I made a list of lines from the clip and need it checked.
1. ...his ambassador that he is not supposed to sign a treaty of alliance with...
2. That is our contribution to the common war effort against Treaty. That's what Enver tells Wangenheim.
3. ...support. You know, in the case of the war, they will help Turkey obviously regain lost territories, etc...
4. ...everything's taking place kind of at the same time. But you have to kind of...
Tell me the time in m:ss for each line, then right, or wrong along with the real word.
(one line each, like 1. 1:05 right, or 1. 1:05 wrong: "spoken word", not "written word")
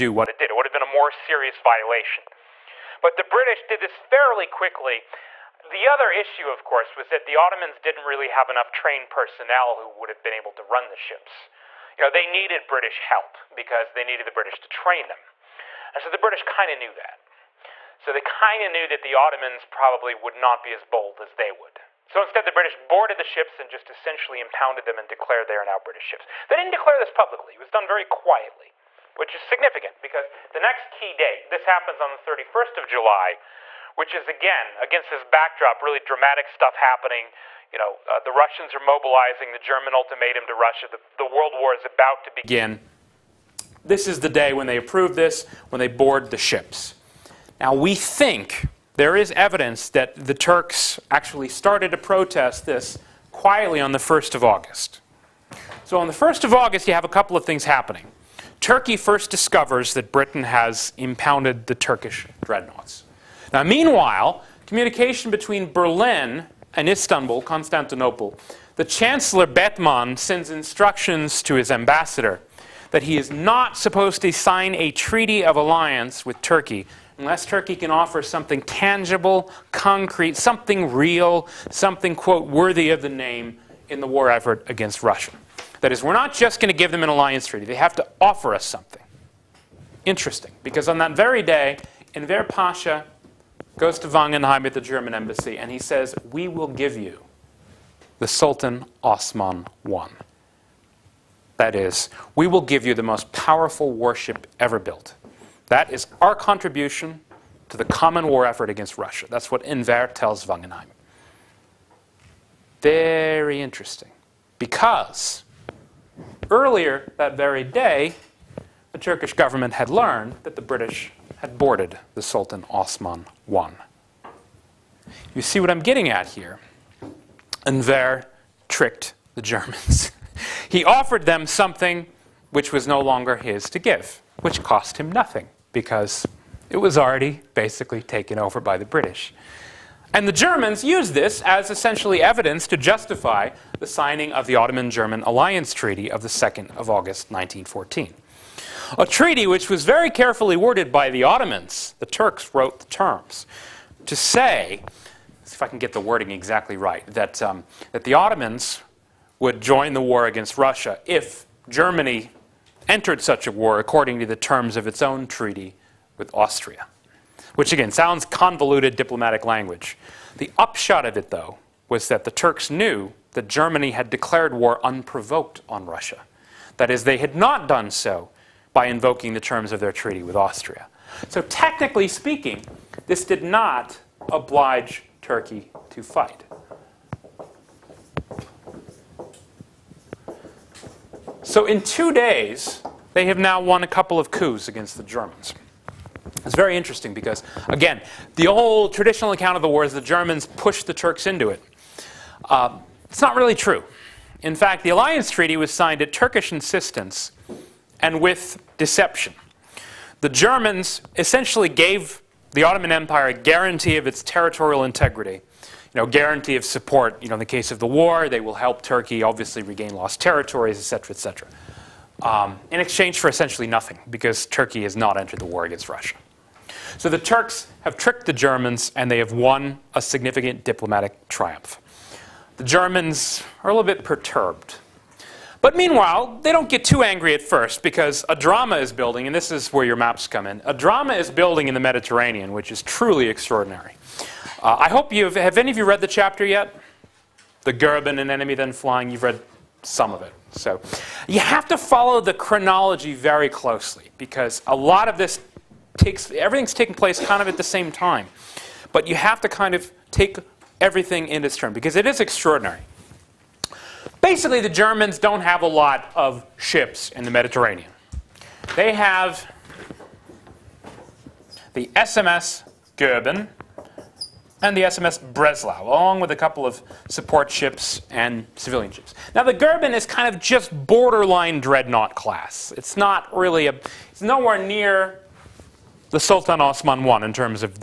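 1. 1:11 right
2. 1:45 wrong: "Russia", not "Treaty"
3. 3:36 right
4. 4:16 right.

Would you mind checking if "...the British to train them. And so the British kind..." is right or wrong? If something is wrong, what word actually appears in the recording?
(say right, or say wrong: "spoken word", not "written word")
right.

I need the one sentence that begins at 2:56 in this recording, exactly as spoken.
That is, they had not done so by invoking the terms of their treaty with Austria.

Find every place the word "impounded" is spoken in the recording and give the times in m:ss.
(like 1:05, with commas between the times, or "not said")
0:24, 1:00.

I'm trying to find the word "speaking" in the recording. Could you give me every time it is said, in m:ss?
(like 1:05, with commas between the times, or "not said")
3:02.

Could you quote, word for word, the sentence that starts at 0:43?
This is the day when they approve this, when they board the ships.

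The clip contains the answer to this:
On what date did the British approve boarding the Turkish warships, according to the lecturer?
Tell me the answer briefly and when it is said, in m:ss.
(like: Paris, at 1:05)
31st of July, at 0:32.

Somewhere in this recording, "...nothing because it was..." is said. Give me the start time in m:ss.
2:15.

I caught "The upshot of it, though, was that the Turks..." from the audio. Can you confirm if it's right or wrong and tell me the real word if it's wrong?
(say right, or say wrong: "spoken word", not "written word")
right.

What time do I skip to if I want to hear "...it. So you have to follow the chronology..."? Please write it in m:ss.
4:10.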